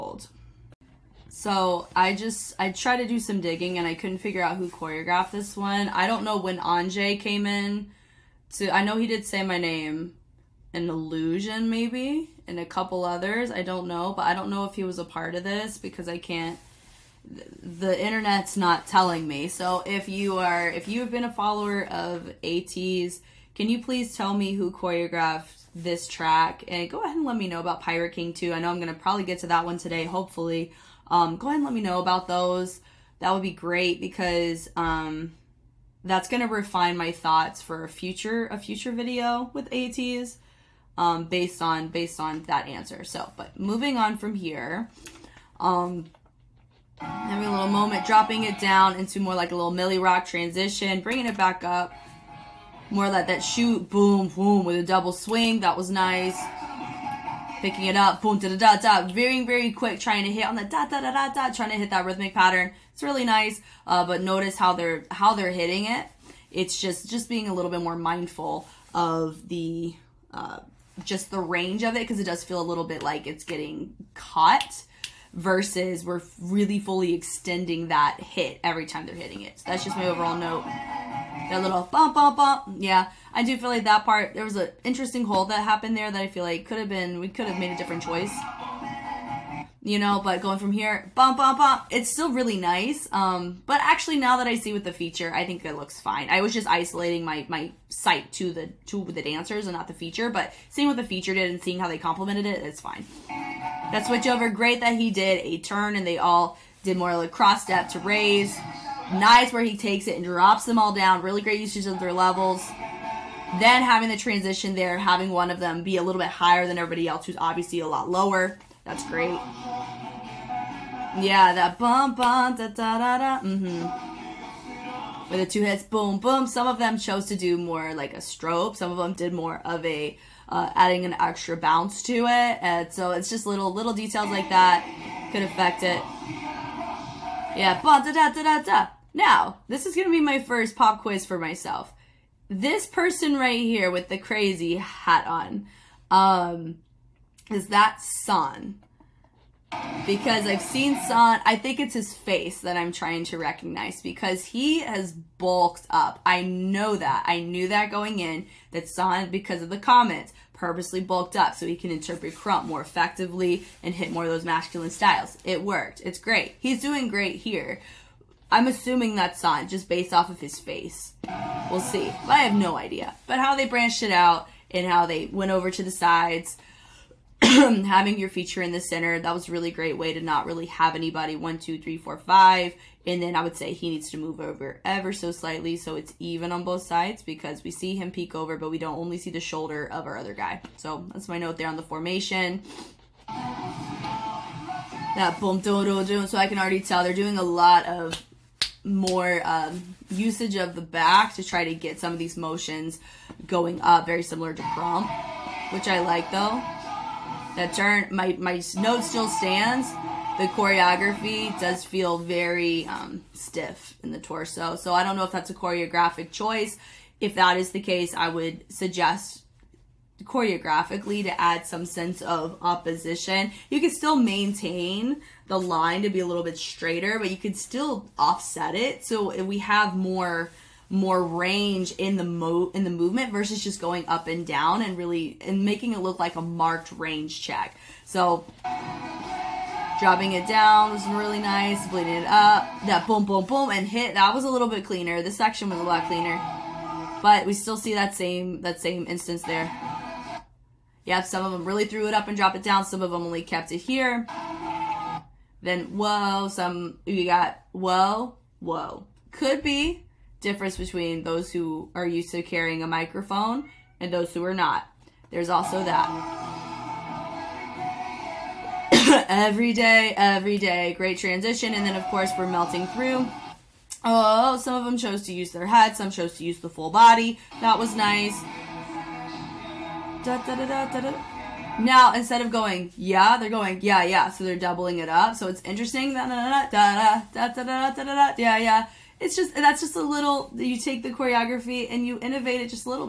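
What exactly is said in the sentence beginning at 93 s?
Um, but actually now that I see with the feature, I think it looks fine.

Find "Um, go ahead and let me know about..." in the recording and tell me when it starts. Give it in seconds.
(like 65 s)
31 s.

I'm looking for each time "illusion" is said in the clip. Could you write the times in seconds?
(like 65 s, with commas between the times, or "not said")
10 s.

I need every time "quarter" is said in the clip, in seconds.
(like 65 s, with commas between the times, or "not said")
not said.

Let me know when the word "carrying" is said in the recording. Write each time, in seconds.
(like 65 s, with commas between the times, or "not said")
262 s.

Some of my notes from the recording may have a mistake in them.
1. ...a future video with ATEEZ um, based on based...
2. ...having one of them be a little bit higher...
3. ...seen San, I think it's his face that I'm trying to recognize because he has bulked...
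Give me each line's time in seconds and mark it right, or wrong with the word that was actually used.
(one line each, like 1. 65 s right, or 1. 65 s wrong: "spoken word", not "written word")
1. 38 s right
2. 114 s right
3. 150 s right.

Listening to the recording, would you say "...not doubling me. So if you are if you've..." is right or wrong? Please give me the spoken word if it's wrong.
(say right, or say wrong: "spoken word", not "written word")
wrong: "telling", not "doubling".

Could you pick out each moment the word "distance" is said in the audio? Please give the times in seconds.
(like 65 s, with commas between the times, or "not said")
not said.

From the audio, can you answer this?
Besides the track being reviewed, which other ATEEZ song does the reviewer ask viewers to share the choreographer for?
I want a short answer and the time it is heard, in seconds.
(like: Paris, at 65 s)
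Pirate King, at 27 s.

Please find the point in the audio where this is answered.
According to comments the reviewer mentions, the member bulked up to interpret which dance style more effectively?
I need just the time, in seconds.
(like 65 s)
162 s.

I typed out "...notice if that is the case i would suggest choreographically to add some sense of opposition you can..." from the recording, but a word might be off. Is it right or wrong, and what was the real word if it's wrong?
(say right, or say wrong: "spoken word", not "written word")
wrong: "choice", not "notice".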